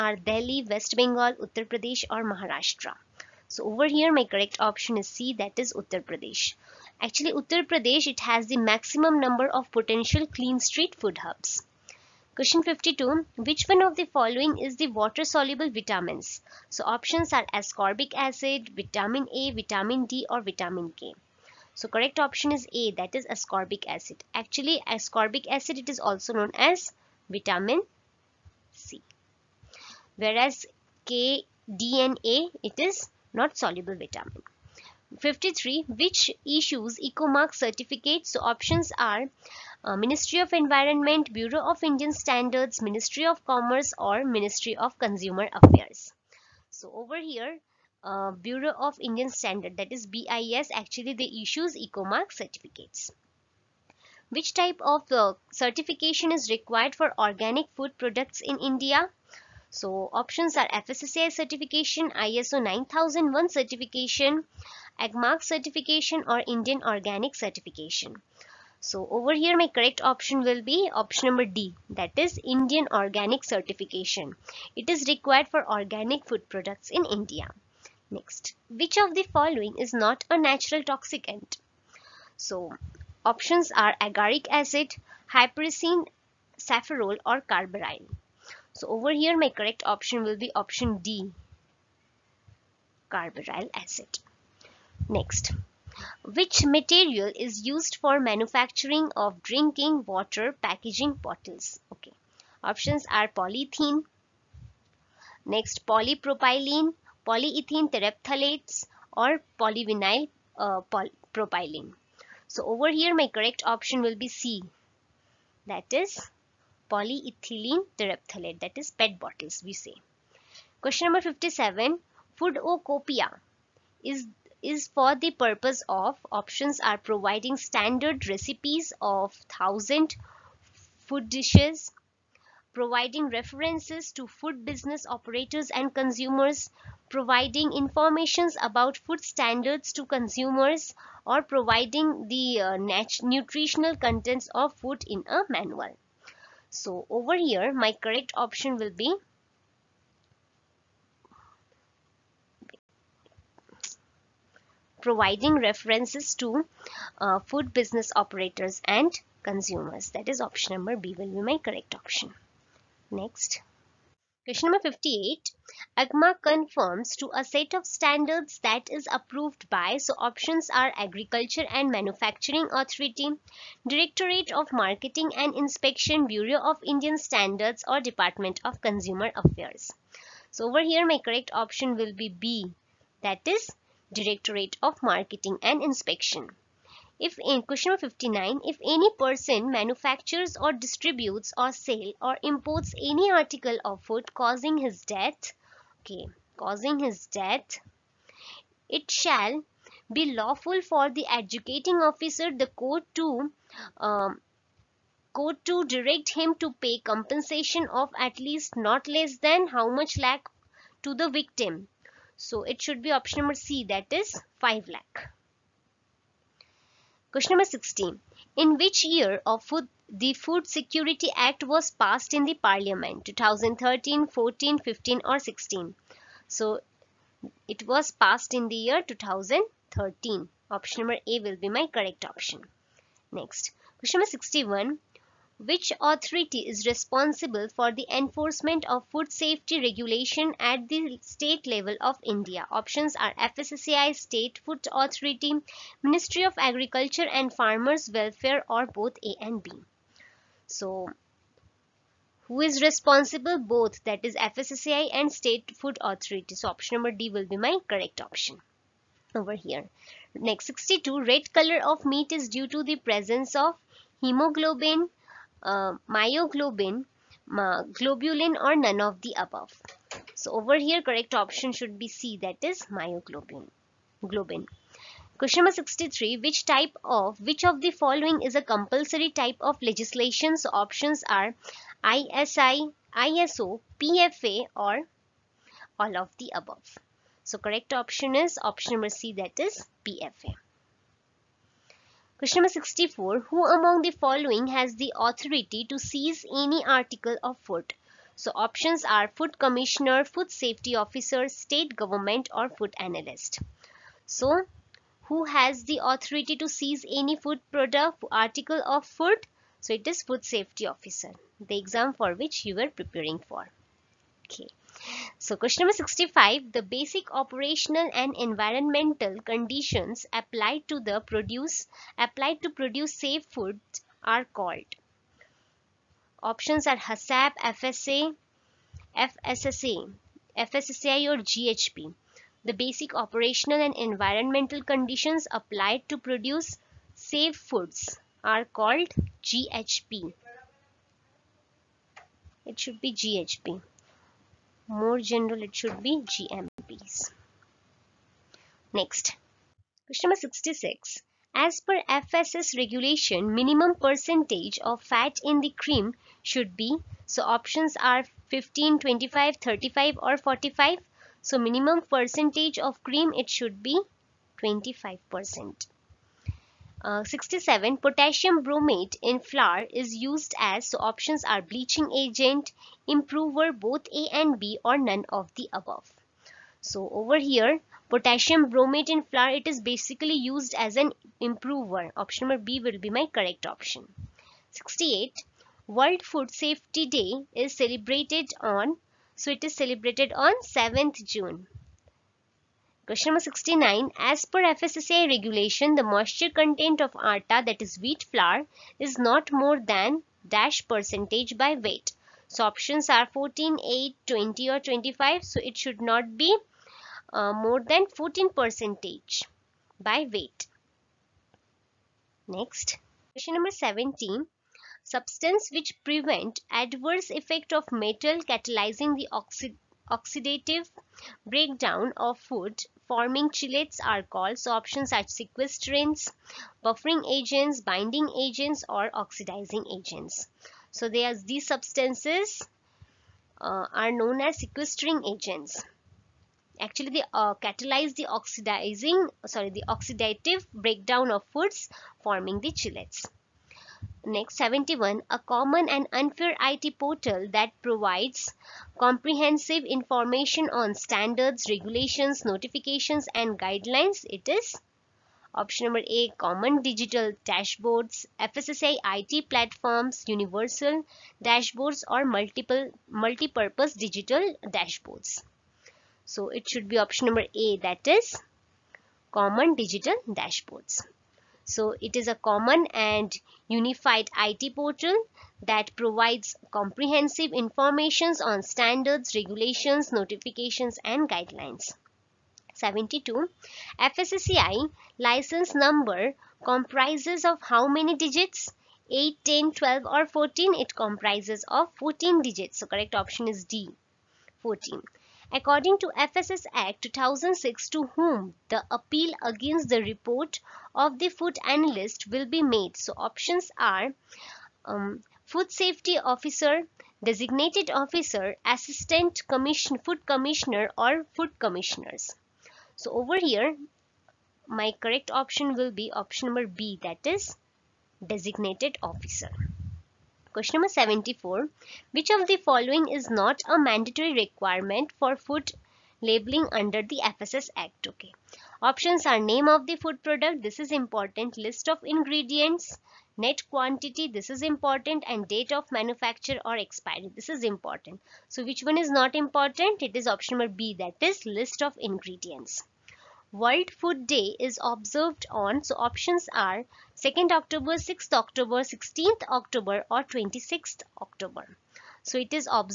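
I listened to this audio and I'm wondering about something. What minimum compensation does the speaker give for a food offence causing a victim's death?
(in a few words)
5 lakh.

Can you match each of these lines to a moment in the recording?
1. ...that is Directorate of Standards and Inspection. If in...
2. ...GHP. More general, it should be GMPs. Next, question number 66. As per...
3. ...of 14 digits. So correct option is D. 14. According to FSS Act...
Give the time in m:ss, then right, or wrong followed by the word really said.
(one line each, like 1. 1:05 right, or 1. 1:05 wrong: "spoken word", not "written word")
1. 3:03 wrong: "Marketing", not "Standards"
2. 5:43 right
3. 8:11 right.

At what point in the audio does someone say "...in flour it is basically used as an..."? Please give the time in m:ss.
6:19.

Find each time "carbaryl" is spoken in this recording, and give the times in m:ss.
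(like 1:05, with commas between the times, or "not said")
1:27, 1:33.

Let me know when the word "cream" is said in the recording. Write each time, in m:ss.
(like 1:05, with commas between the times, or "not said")
5:55, 6:03.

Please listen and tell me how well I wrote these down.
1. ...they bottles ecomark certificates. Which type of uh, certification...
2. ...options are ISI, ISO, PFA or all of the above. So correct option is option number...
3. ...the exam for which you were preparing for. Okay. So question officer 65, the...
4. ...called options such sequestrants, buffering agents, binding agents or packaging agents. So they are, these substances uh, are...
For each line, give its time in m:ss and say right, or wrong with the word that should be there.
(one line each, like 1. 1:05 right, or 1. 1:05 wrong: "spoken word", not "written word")
1. 0:51 wrong: "issues", not "bottles"
2. 4:40 right
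3. 5:11 wrong: "number", not "officer"
4. 7:04 wrong: "oxidizing", not "packaging".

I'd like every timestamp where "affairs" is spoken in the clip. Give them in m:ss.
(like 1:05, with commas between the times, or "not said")
0:45, 2:59.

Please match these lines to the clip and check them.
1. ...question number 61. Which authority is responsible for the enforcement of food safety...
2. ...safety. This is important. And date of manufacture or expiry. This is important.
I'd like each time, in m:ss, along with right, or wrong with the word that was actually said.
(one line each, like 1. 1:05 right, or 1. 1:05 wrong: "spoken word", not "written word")
1. 3:53 right
2. 8:53 wrong: "quantity", not "safety".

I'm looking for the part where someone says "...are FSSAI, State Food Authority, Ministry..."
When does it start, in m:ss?
4:03.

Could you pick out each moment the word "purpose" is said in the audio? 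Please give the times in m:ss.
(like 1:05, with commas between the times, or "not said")
2:05, 7:43.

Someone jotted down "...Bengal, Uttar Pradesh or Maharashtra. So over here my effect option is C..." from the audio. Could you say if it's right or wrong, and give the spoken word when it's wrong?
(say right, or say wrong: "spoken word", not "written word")
wrong: "correct", not "effect".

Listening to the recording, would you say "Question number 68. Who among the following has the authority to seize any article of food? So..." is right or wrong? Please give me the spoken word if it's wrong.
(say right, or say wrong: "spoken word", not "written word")
wrong: "64", not "68".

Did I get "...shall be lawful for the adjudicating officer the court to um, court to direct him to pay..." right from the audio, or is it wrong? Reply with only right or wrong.
right.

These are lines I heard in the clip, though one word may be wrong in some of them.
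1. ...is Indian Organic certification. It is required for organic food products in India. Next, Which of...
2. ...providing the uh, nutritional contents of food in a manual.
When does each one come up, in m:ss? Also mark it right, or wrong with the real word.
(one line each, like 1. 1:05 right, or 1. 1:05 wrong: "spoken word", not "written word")
1. 1:12 right
2. 2:21 right.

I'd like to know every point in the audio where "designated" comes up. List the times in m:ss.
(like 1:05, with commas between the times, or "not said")
8:27, 8:38.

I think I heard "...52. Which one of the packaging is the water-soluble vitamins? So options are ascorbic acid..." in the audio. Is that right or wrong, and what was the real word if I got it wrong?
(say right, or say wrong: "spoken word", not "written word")
wrong: "following", not "packaging".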